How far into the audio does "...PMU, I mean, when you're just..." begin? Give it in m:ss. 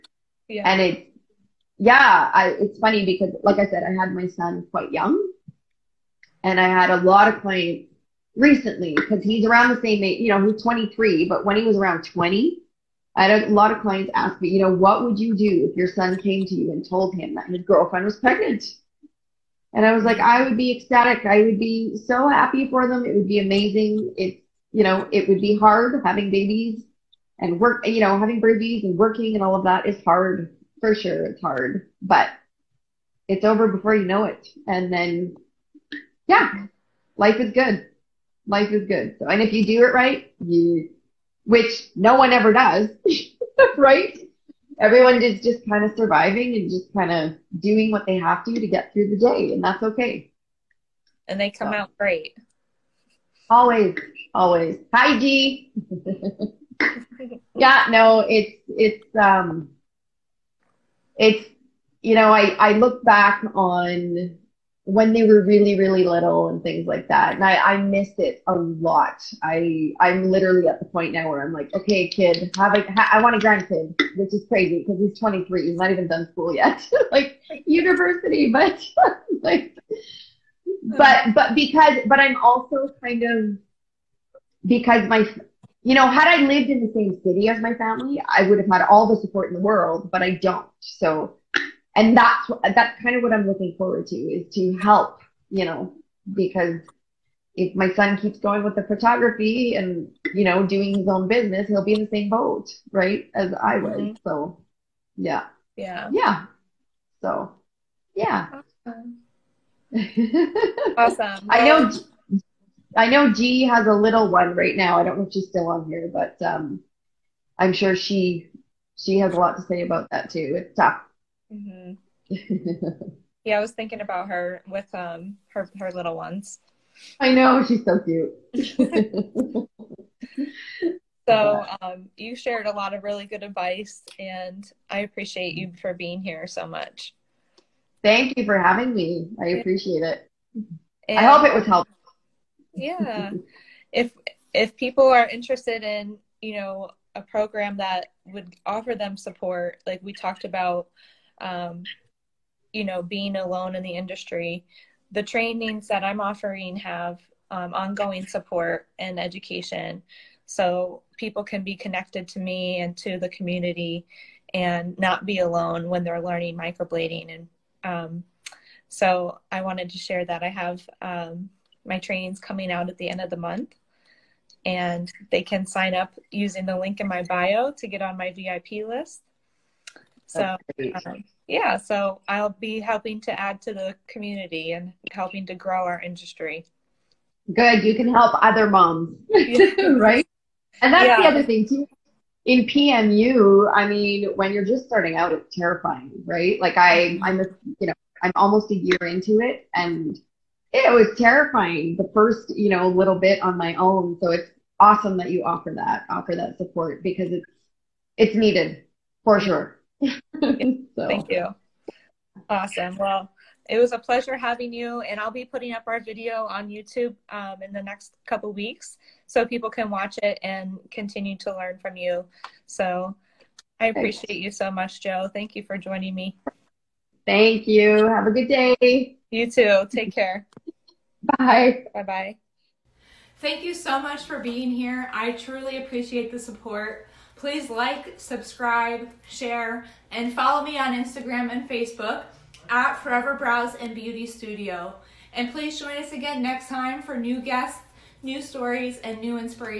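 3:12.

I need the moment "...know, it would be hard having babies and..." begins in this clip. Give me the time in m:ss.
0:24.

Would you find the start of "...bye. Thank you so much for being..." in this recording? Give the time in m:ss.
3:52.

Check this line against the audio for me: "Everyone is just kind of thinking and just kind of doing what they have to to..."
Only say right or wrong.
wrong.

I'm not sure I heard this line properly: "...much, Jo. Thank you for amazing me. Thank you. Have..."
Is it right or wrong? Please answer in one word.
wrong.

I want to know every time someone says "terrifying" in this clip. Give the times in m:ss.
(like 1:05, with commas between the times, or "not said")
3:15, 3:21.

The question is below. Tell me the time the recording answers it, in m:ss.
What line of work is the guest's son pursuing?
1:38.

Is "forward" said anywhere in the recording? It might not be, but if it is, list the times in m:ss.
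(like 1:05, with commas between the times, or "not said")
1:33.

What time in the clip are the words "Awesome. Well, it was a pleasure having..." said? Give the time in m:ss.
3:32.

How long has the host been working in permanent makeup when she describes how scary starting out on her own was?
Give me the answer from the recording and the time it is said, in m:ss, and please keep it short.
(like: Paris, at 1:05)
Almost a year, at 3:18.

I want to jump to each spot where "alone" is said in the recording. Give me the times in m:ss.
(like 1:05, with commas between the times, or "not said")
2:33, 2:45.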